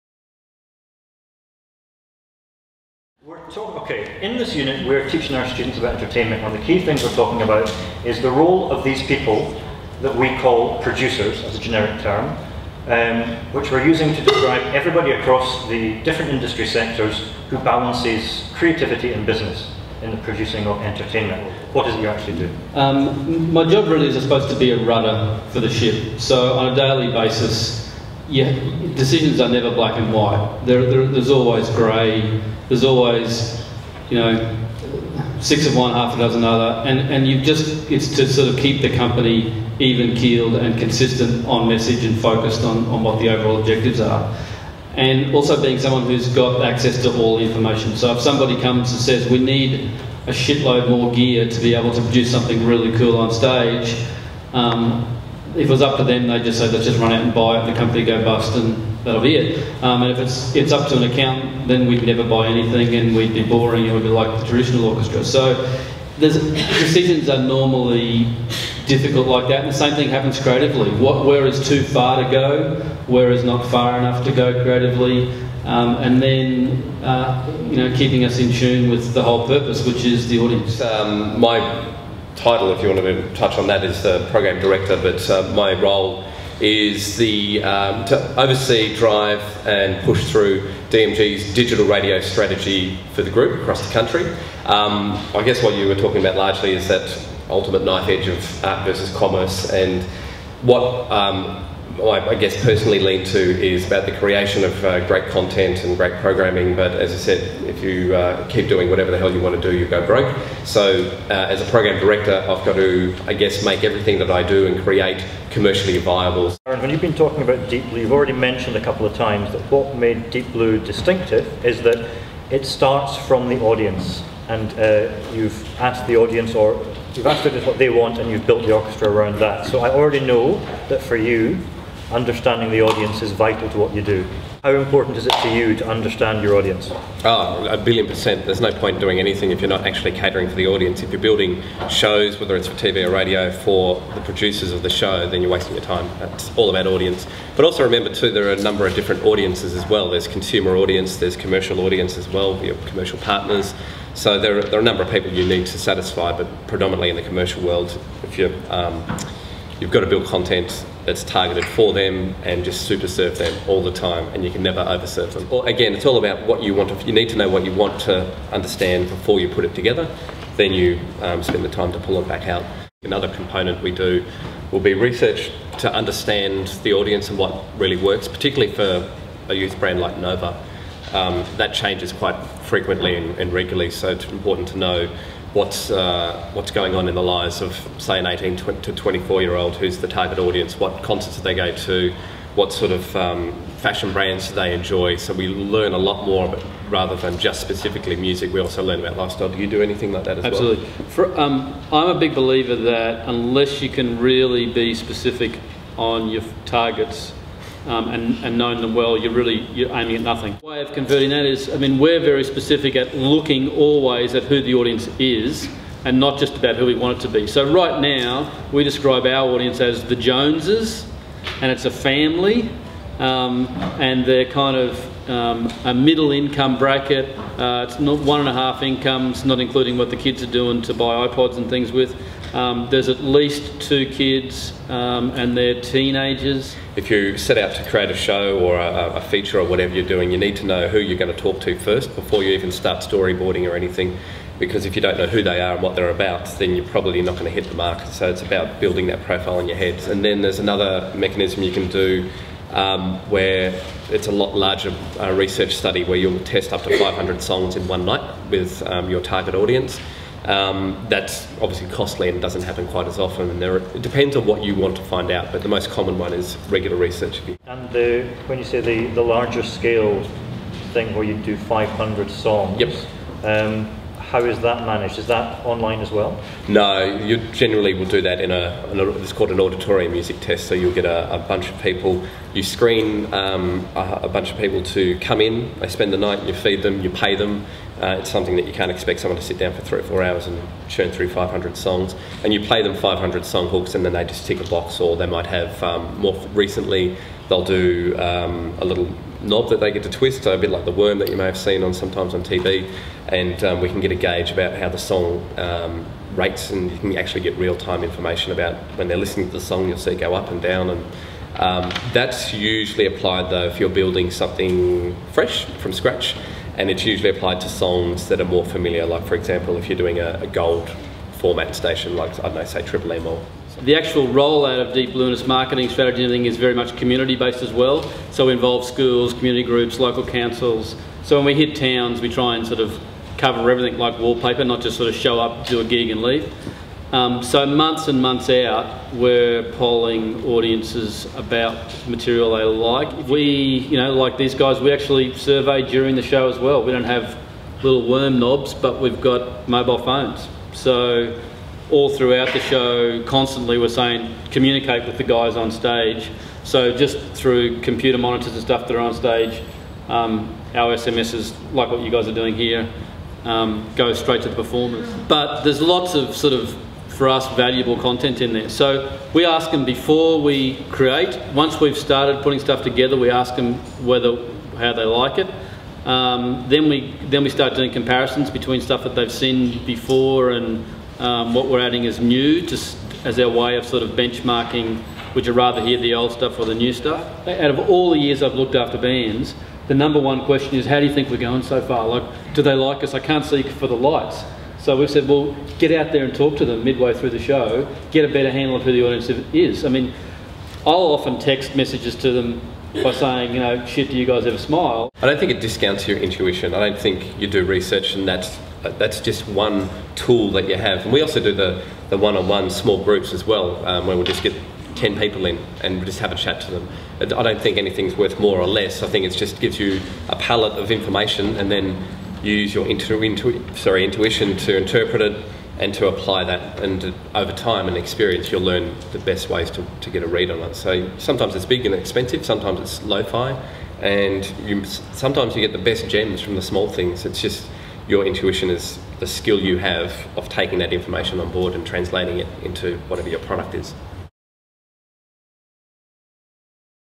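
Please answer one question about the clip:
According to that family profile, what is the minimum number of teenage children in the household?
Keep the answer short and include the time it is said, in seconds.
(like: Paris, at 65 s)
2, at 233 s.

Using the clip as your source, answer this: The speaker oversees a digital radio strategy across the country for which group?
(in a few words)
DMG.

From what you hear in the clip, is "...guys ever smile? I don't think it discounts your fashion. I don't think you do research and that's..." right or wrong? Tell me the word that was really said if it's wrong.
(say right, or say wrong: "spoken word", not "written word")
wrong: "intuition", not "fashion".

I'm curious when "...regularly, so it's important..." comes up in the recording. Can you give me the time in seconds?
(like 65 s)
183 s.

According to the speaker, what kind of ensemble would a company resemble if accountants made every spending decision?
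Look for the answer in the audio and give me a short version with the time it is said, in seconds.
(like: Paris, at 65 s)
traditional orchestra, at 64 s.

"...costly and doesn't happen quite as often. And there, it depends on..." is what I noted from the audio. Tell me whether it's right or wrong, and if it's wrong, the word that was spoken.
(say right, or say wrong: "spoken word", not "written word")
right.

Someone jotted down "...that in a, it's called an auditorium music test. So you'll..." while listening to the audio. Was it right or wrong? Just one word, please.
right.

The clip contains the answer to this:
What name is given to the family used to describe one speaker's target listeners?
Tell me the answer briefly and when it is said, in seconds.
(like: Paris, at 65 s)
the Joneses, at 220 s.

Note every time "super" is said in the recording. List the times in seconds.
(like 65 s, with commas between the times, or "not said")
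162 s.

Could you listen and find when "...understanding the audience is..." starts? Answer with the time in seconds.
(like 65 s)
132 s.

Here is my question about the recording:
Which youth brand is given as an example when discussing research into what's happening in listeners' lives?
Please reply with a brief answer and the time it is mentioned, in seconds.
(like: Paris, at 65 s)
Nova, at 180 s.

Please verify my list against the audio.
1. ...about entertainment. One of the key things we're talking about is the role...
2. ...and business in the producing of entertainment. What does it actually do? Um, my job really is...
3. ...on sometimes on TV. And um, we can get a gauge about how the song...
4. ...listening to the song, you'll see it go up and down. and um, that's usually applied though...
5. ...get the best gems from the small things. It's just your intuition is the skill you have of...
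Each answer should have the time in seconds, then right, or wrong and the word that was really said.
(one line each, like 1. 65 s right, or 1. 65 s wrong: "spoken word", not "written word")
1. 5 s right
2. 19 s right
3. 301 s right
4. 309 s right
5. 435 s right.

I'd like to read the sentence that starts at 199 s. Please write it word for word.
Do you do anything like that as Absolutely.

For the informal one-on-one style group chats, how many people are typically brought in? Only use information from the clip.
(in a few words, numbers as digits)
10.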